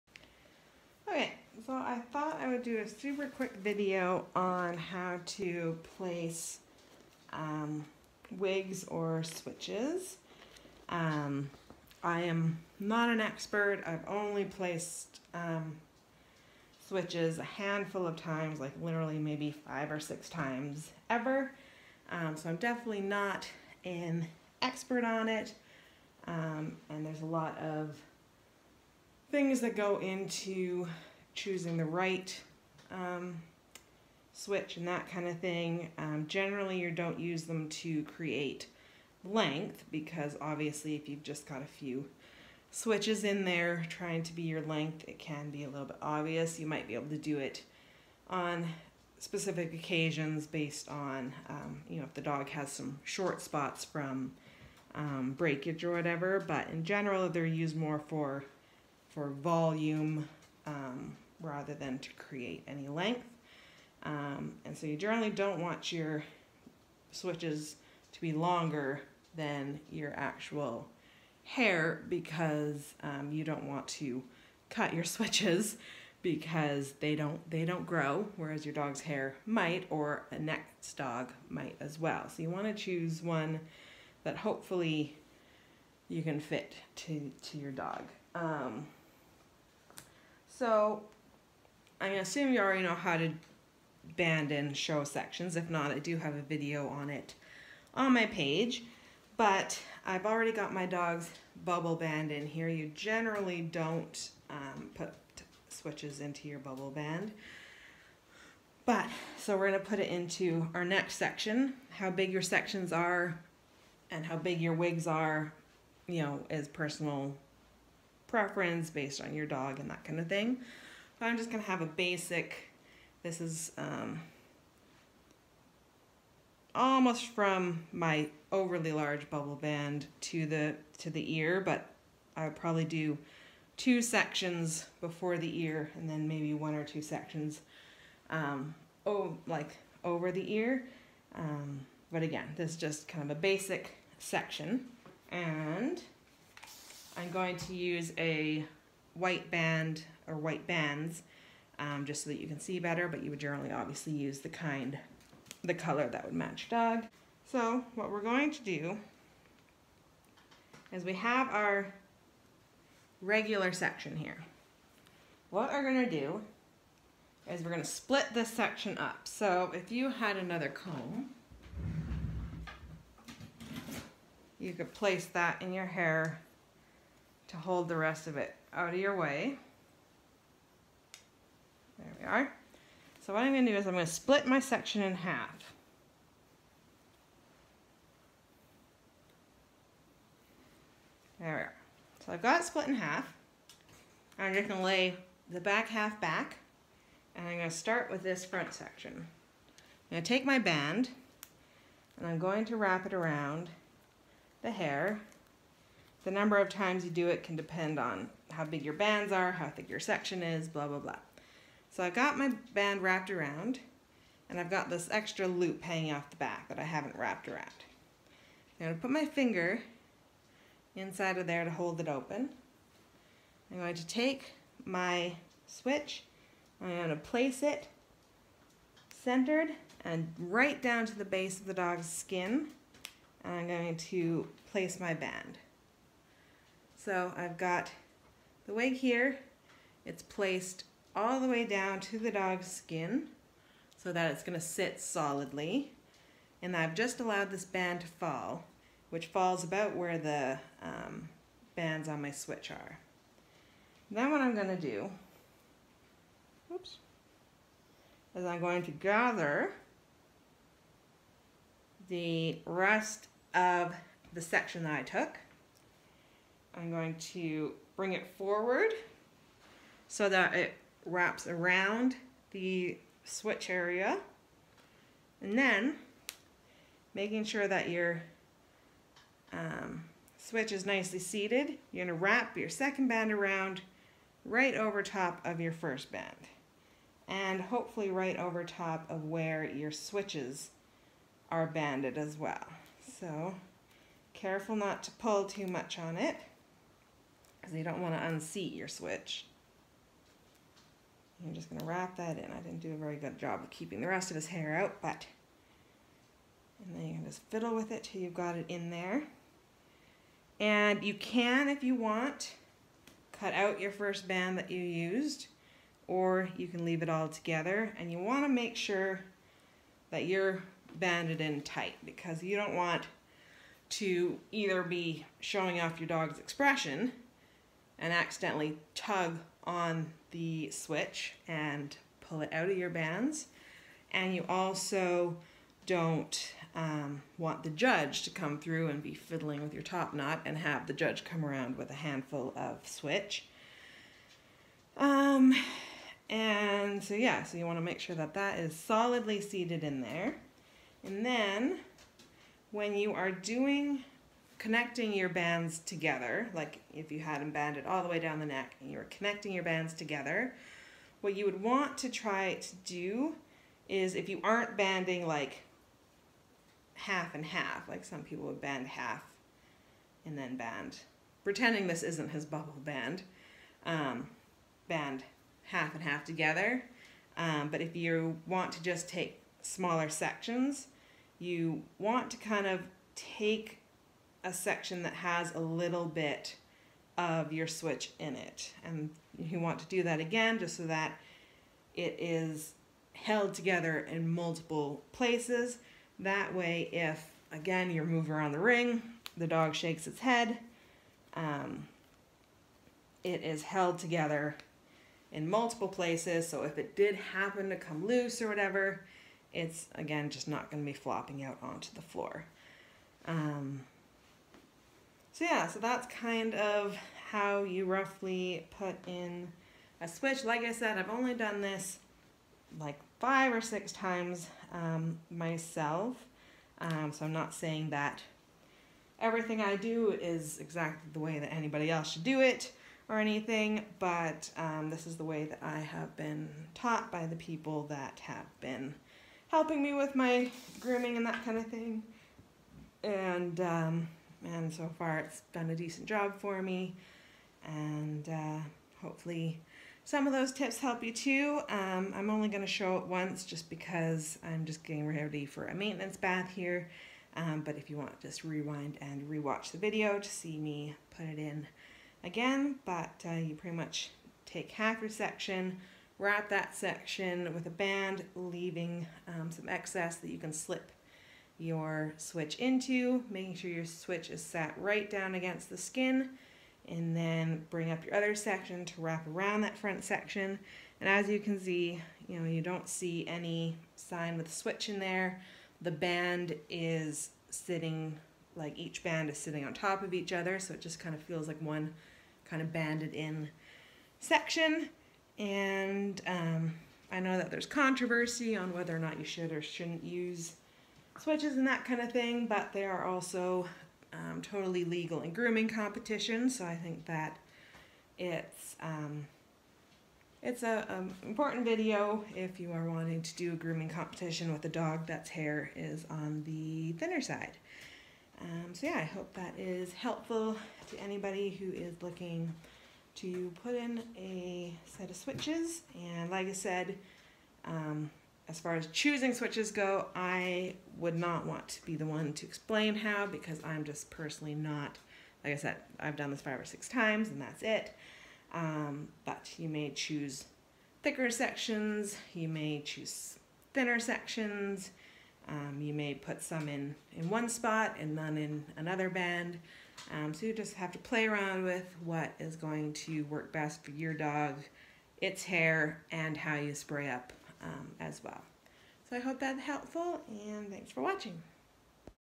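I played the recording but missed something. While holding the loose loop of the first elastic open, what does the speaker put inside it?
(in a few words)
finger.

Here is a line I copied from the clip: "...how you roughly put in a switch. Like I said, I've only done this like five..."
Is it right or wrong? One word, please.
right.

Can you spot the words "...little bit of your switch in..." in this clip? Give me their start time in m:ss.
6:25.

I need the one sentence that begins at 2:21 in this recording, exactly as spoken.
Um, but again, this is just kind of a basic section.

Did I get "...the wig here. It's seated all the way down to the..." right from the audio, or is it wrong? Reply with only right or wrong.
wrong.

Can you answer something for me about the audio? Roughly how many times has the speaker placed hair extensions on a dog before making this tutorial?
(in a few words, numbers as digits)
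5 or 6.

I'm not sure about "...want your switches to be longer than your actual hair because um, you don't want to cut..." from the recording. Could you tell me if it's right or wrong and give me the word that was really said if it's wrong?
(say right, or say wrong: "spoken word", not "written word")
right.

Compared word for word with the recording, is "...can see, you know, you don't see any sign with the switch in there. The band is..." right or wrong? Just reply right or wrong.
right.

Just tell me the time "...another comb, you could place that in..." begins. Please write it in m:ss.
2:50.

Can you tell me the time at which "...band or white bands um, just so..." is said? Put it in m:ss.
2:29.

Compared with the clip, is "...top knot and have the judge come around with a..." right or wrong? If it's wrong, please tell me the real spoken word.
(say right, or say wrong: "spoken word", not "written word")
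right.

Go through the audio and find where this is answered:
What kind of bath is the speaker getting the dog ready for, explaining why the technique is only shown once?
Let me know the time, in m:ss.
7:35.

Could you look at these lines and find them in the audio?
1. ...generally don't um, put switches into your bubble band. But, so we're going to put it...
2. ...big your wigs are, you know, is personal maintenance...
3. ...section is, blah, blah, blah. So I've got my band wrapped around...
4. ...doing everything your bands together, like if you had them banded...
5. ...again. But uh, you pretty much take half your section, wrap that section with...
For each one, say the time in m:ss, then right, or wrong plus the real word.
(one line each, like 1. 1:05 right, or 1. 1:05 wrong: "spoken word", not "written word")
1. 1:42 right
2. 1:54 wrong: "preference", not "maintenance"
3. 3:29 right
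4. 5:53 wrong: "connecting", not "everything"
5. 7:42 right.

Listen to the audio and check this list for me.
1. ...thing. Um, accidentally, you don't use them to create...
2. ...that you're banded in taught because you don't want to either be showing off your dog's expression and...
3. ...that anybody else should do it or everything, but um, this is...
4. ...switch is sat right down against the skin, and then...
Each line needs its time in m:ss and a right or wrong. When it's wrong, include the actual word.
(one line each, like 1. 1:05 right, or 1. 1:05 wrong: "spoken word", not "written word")
1. 0:35 wrong: "generally", not "accidentally"
2. 5:20 wrong: "tight", not "taught"
3. 7:11 wrong: "anything", not "everything"
4. 7:53 right.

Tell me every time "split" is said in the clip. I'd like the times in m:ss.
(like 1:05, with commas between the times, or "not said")
2:47, 3:04, 3:12.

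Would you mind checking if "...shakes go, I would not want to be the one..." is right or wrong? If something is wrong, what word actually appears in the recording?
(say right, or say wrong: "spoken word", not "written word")
wrong: "switches", not "shakes".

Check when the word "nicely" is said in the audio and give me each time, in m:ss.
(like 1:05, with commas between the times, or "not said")
4:40.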